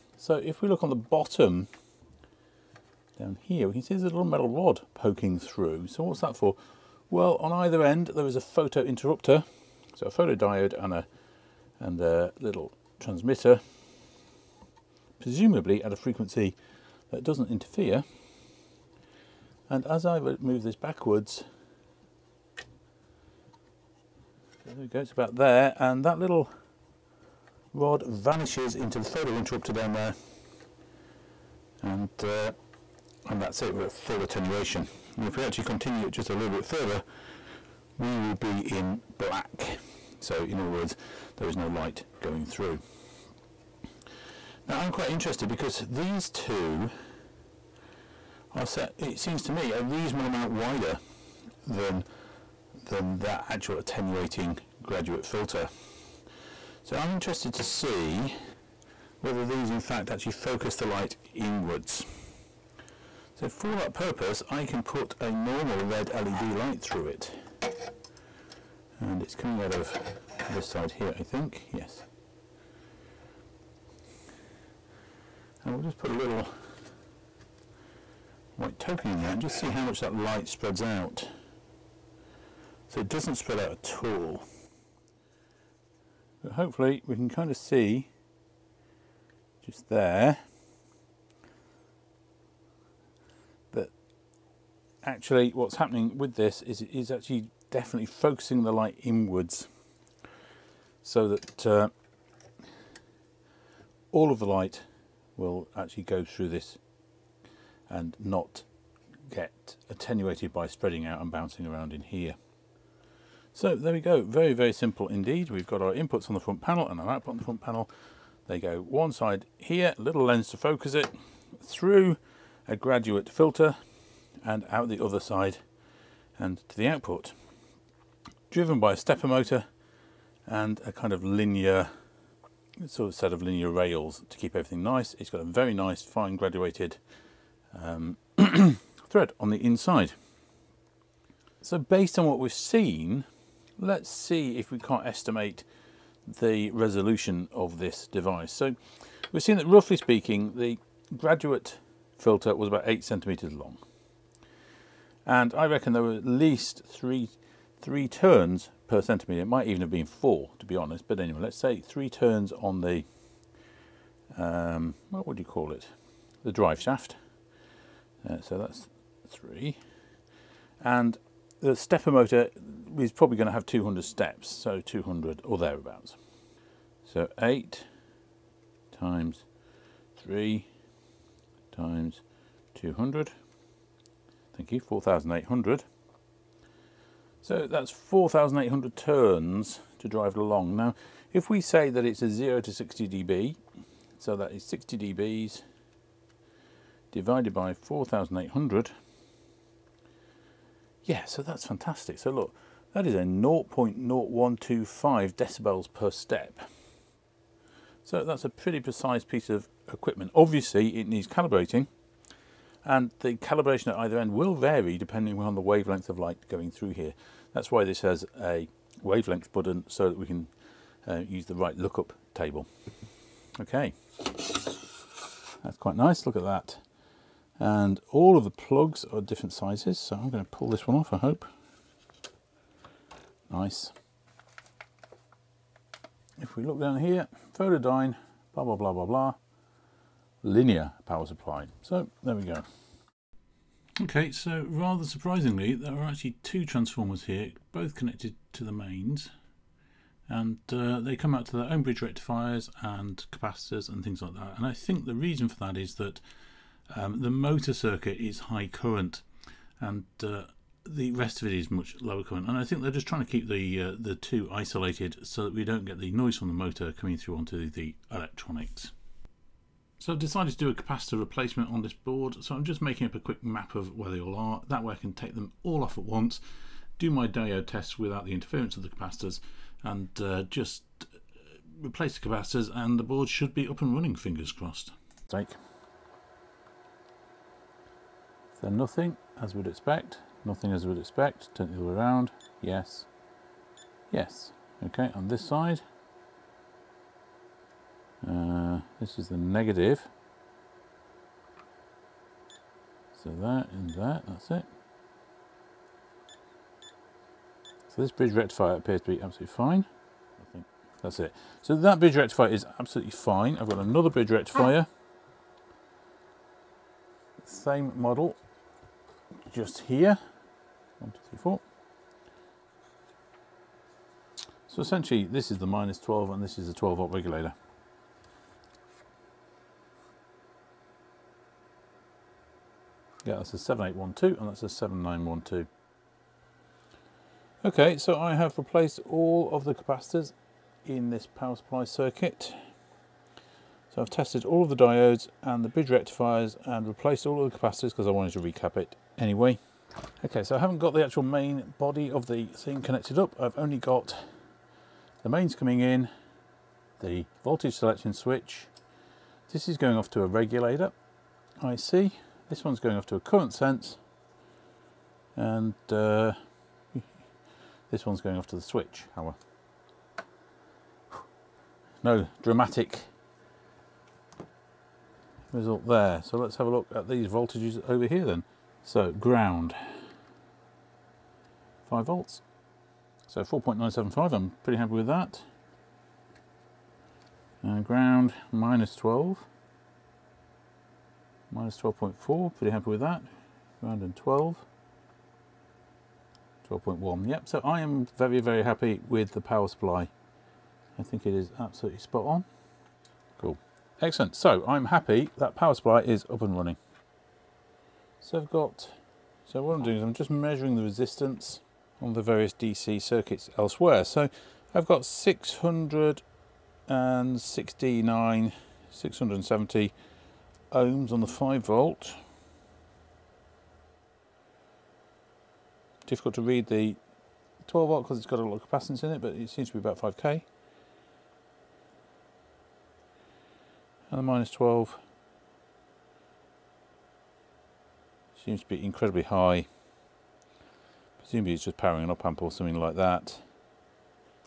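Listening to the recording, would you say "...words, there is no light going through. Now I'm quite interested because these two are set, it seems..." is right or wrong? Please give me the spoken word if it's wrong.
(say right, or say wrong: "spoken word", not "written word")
right.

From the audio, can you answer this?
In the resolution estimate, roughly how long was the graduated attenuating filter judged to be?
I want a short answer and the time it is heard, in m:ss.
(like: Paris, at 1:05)
8 centimeters, at 2:32.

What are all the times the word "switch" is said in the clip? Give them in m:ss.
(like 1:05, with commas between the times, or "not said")
5:58, 6:08.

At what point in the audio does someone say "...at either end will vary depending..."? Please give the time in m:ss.
3:33.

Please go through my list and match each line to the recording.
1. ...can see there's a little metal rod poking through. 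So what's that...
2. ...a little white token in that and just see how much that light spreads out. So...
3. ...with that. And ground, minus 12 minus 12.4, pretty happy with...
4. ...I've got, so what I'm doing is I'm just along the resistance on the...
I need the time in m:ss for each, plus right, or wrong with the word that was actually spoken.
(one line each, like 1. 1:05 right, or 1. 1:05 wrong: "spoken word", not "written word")
1. 0:03 right
2. 1:16 right
3. 6:24 right
4. 6:48 wrong: "measuring", not "along".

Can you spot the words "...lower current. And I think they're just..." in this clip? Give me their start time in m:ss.
4:21.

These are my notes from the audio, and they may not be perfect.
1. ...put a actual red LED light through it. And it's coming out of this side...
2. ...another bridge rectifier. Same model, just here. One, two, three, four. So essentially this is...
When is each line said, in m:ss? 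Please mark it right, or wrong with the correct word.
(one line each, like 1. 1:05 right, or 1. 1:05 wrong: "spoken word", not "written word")
1. 1:04 wrong: "normal", not "actual"
2. 5:13 right.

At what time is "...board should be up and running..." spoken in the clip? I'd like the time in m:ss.
4:43.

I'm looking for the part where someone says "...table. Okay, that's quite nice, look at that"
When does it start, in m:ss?
3:42.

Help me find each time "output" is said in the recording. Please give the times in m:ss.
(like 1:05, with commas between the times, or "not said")
1:57, 2:06.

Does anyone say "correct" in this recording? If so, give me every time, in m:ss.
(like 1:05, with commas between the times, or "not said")
not said.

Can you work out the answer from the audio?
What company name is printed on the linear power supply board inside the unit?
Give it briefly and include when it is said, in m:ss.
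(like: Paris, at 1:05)
Photodyne, at 3:57.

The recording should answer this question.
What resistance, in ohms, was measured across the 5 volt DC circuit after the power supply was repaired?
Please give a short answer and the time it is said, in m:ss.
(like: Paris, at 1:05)
670 ohms, at 6:58.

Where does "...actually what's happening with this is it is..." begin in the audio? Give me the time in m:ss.
1:35.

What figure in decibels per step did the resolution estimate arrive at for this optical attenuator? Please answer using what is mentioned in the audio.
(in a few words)
0.0125.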